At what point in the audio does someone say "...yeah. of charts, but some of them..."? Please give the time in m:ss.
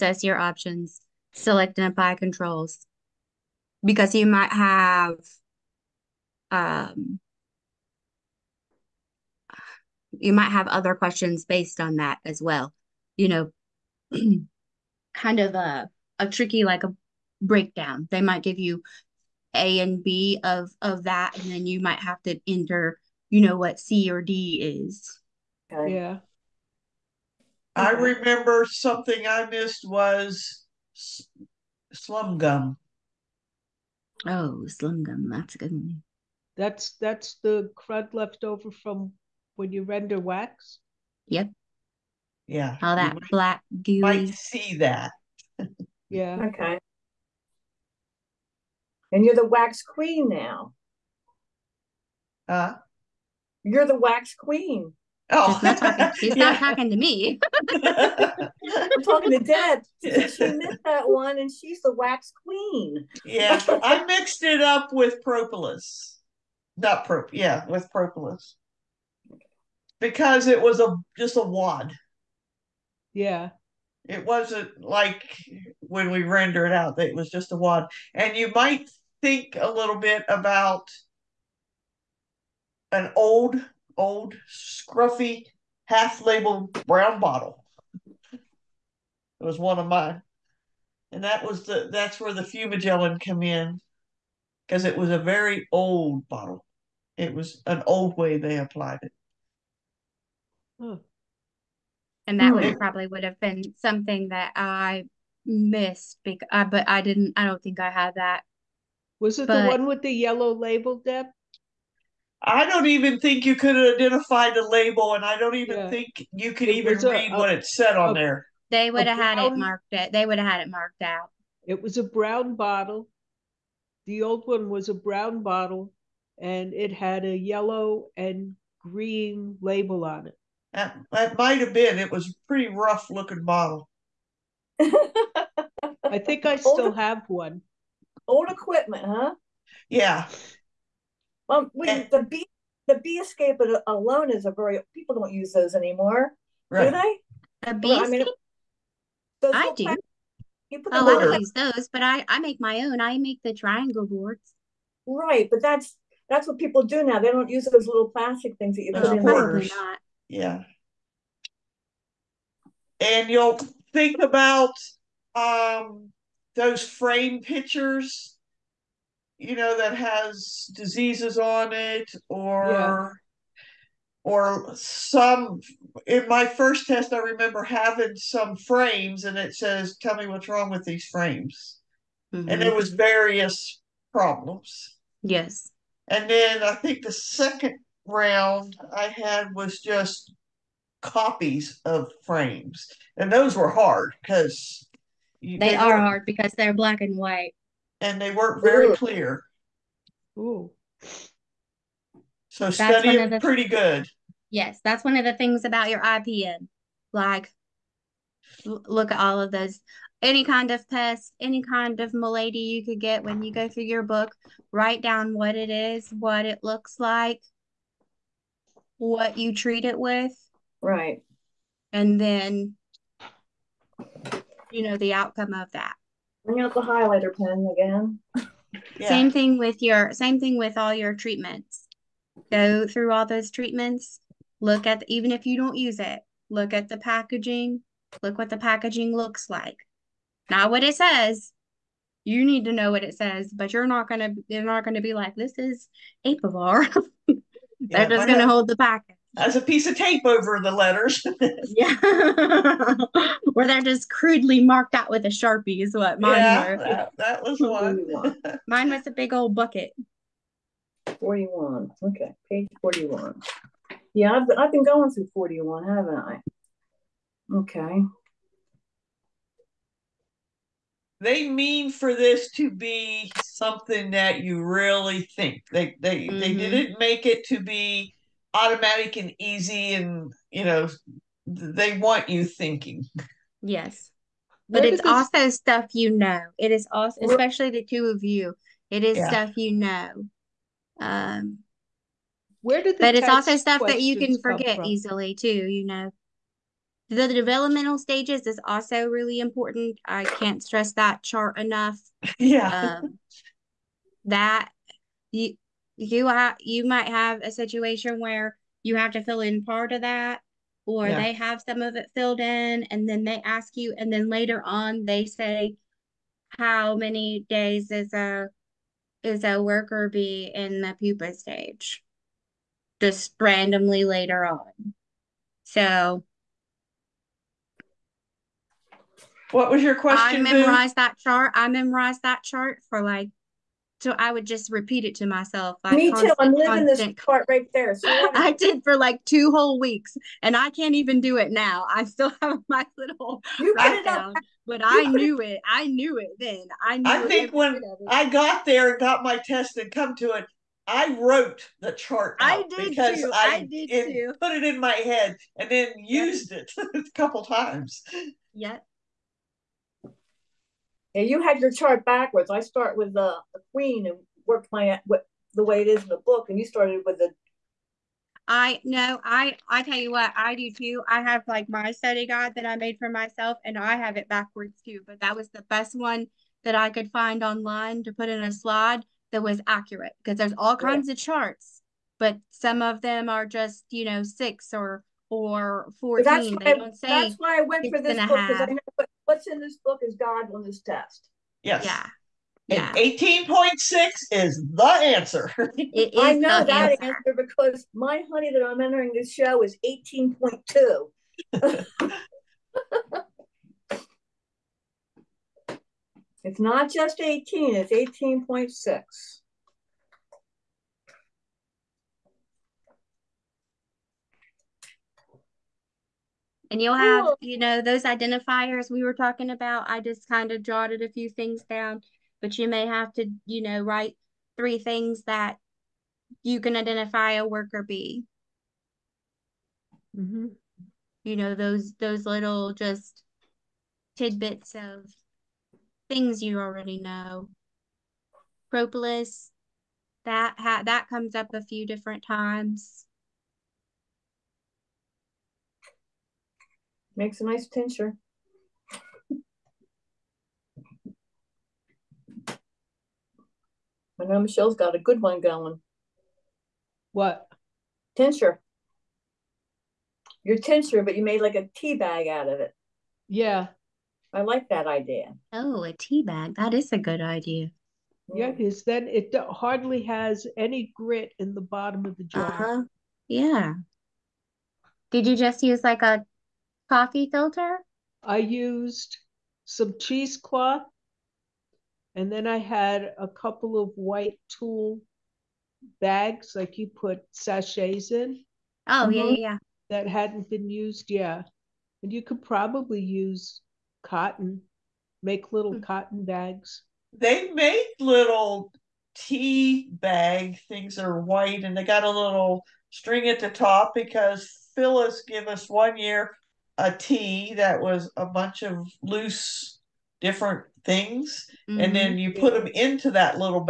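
6:21.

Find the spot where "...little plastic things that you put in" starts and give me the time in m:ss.
2:37.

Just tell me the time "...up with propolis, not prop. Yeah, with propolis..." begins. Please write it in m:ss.
1:04.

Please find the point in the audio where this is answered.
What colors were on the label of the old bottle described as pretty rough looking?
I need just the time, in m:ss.
2:07.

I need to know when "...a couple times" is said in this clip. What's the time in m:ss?
5:56.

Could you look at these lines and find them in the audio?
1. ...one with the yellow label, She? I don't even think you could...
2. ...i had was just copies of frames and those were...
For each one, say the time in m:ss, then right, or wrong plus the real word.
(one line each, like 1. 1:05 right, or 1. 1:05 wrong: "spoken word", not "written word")
1. 1:49 wrong: "Deb", not "She"
2. 3:08 right.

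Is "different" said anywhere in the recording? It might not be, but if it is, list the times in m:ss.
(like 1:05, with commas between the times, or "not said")
7:21, 8:30.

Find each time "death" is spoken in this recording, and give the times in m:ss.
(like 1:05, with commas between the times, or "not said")
not said.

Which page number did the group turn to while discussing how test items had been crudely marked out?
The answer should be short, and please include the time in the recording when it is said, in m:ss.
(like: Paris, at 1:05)
41, at 4:22.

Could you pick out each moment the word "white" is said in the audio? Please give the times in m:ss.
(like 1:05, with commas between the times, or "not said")
3:17, 8:03, 8:21.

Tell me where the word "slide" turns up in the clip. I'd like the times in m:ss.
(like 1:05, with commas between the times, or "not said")
6:18.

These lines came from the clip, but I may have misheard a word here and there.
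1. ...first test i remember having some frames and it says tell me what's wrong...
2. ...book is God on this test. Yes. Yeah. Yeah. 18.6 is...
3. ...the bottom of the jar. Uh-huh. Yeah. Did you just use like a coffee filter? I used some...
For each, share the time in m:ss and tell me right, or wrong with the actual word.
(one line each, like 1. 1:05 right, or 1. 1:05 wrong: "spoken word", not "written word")
1. 2:56 right
2. 6:29 right
3. 7:51 right.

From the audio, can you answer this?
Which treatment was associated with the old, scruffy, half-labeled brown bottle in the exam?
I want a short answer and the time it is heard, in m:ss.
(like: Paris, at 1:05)
fumagillin, at 1:32.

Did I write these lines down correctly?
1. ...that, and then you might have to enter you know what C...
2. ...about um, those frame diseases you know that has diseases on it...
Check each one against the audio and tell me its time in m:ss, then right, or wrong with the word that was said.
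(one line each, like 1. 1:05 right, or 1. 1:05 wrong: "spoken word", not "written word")
1. 0:21 right
2. 2:44 wrong: "pictures", not "diseases".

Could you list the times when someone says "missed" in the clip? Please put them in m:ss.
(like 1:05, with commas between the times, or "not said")
0:29, 1:00, 1:45.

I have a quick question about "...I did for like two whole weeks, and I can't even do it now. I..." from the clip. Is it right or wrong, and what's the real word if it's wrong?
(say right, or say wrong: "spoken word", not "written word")
right.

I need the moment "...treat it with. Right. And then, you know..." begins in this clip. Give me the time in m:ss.
3:39.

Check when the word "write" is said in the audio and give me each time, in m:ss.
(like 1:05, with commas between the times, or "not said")
3:34, 5:43, 7:03.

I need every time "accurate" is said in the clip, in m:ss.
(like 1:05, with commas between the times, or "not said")
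6:19.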